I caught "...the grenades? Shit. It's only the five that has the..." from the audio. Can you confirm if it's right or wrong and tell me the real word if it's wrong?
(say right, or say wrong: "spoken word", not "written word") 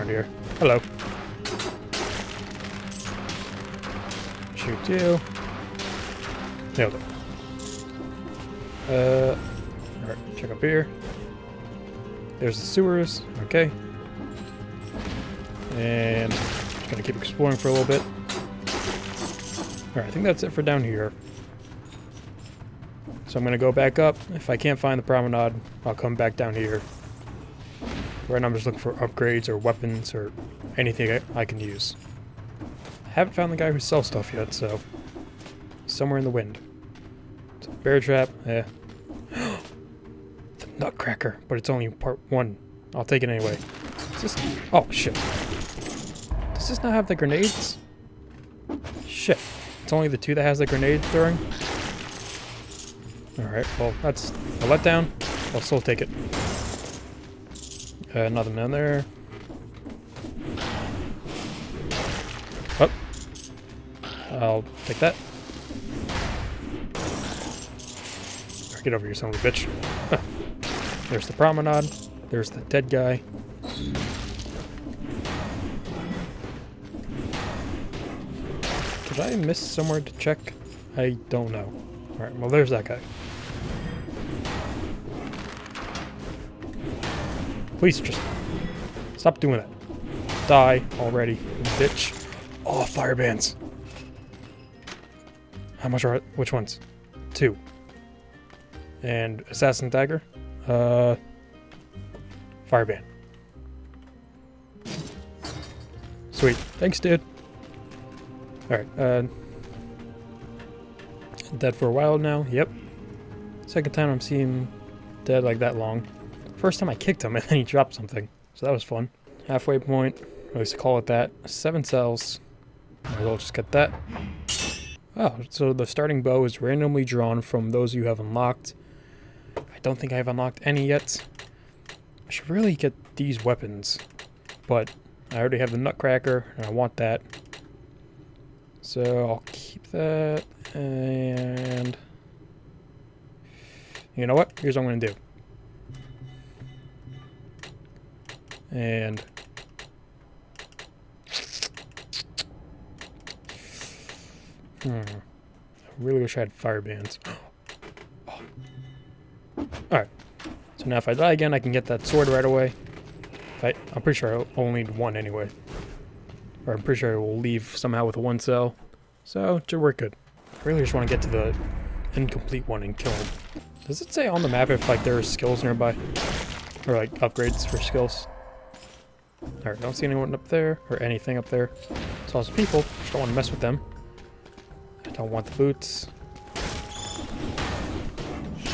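wrong: "two", not "five".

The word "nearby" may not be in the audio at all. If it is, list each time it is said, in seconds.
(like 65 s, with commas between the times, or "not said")
175 s.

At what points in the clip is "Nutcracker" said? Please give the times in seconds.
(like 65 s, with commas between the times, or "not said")
40 s, 135 s.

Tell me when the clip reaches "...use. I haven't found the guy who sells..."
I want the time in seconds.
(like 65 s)
31 s.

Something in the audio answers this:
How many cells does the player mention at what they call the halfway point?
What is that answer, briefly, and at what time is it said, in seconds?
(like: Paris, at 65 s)
7, at 121 s.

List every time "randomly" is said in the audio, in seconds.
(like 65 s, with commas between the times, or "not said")
126 s.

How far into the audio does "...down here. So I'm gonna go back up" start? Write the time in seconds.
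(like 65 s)
20 s.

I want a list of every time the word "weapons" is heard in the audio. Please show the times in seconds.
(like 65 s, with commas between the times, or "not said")
29 s, 133 s.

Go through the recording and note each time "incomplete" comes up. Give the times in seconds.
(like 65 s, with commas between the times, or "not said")
172 s.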